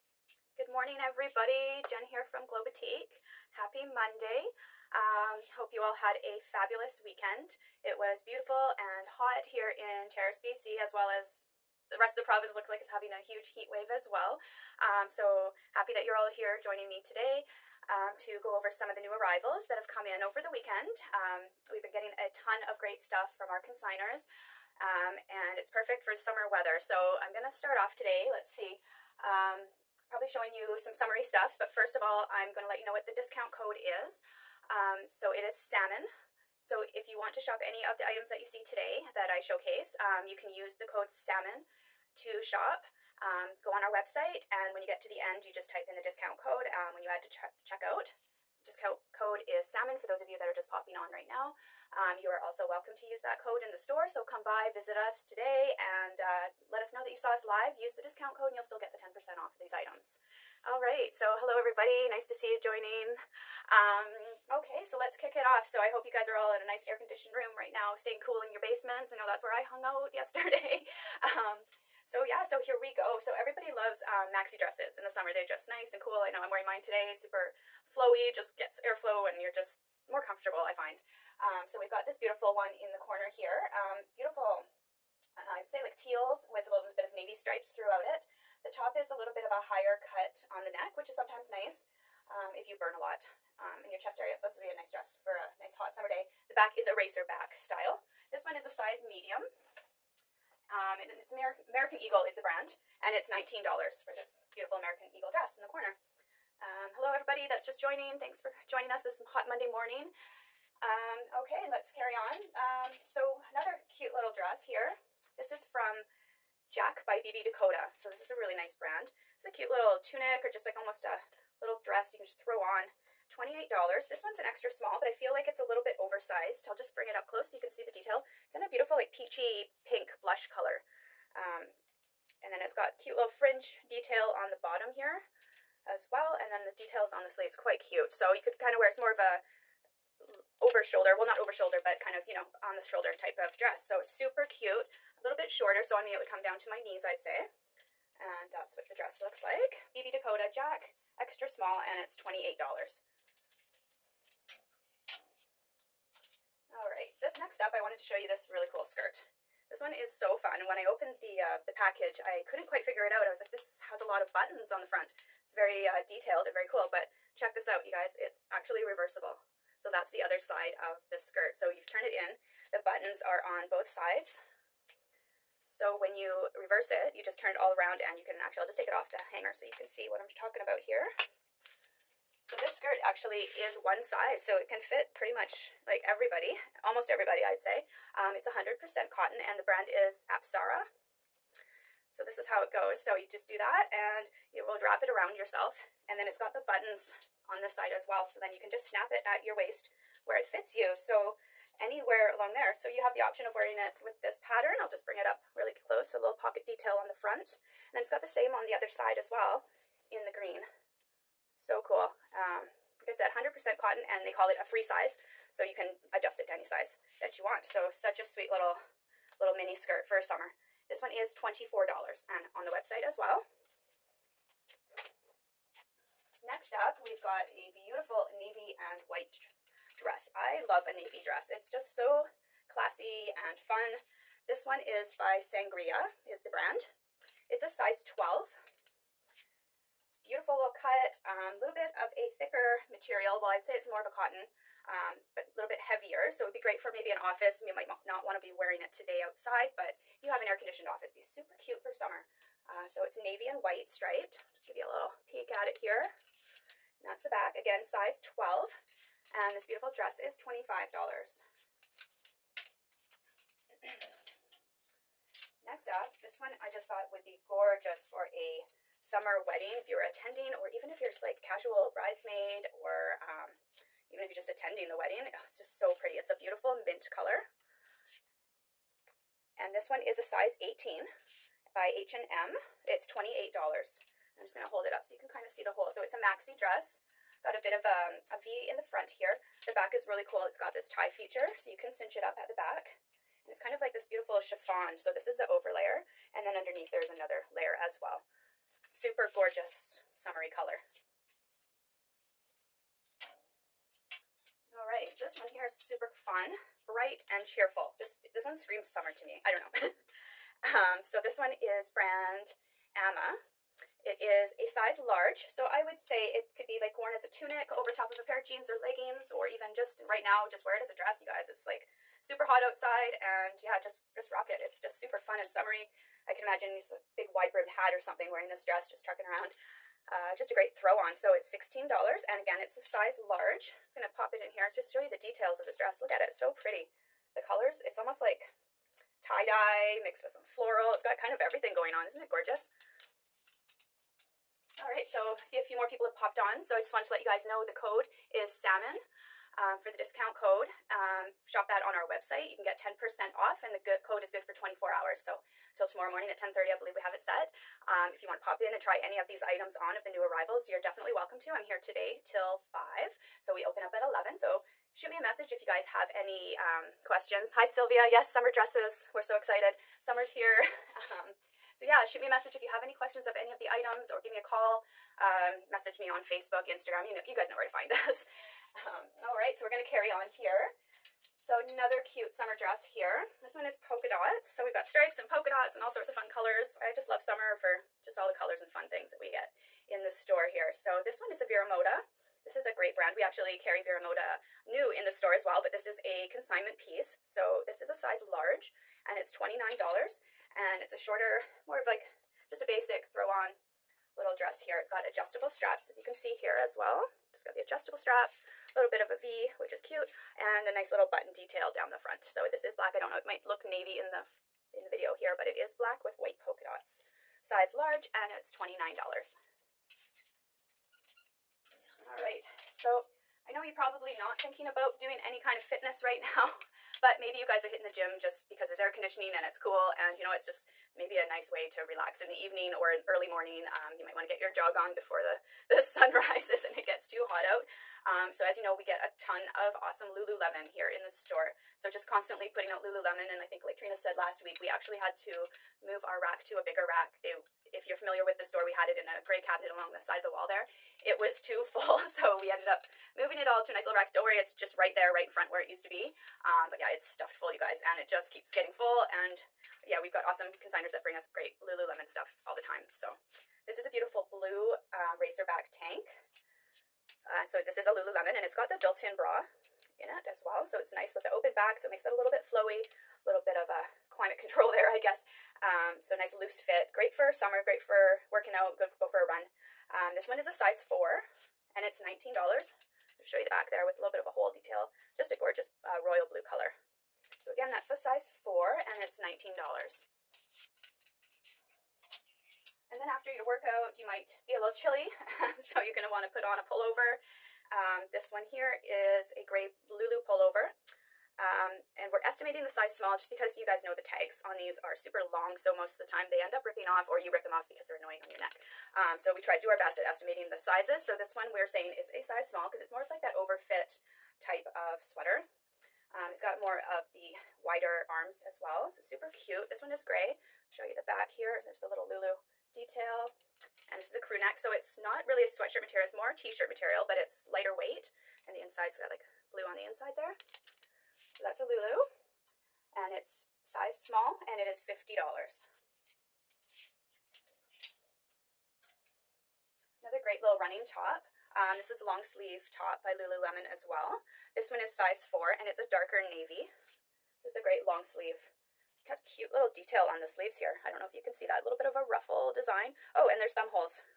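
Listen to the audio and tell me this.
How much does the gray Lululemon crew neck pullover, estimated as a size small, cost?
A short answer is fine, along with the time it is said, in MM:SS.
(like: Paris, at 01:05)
$50, at 08:54.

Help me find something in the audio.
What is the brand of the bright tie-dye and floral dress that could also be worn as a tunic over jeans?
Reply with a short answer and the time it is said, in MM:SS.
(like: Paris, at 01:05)
Amma, at 05:12.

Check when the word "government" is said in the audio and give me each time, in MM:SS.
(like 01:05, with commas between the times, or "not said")
not said.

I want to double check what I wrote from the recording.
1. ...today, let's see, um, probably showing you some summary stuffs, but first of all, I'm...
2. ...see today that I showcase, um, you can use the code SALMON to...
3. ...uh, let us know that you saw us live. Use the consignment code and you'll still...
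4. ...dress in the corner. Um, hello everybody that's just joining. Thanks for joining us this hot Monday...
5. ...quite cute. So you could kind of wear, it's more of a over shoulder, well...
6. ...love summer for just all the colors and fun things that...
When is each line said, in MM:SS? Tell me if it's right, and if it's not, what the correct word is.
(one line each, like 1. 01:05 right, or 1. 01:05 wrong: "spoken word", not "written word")
1. 00:27 right
2. 00:38 right
3. 00:56 wrong: "discount", not "consignment"
4. 01:45 right
5. 02:17 right
6. 06:27 right.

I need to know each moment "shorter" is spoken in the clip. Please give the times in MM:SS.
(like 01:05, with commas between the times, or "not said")
02:25, 06:40.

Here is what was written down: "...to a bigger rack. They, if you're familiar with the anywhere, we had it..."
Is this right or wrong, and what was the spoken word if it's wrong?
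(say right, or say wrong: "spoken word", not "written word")
wrong: "store", not "anywhere".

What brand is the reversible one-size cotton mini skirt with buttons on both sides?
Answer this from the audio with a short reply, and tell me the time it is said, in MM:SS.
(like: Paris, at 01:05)
Apsara, at 03:10.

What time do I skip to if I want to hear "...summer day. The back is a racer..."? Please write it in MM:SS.
01:35.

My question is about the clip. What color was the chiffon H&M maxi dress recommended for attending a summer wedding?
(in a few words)
mint.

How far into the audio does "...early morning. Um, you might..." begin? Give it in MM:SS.
07:13.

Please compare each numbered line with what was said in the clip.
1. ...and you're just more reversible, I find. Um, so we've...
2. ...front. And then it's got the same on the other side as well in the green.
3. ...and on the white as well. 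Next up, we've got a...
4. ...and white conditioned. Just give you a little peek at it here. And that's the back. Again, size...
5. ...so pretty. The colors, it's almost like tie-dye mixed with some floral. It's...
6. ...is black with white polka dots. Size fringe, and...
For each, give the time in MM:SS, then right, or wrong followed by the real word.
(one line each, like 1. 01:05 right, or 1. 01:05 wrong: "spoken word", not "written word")
1. 01:19 wrong: "comfortable", not "reversible"
2. 03:27 right
3. 03:42 wrong: "website", not "white"
4. 04:13 wrong: "striped", not "conditioned"
5. 05:36 right
6. 06:55 wrong: "large", not "fringe".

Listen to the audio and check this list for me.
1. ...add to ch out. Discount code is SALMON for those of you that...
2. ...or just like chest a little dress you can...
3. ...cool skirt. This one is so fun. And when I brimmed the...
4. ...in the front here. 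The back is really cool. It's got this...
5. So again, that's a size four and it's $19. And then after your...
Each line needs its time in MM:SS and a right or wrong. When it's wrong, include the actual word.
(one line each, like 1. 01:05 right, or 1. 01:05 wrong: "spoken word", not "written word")
1. 00:47 right
2. 02:00 wrong: "almost", not "chest"
3. 02:38 wrong: "opened", not "brimmed"
4. 04:48 right
5. 08:07 right.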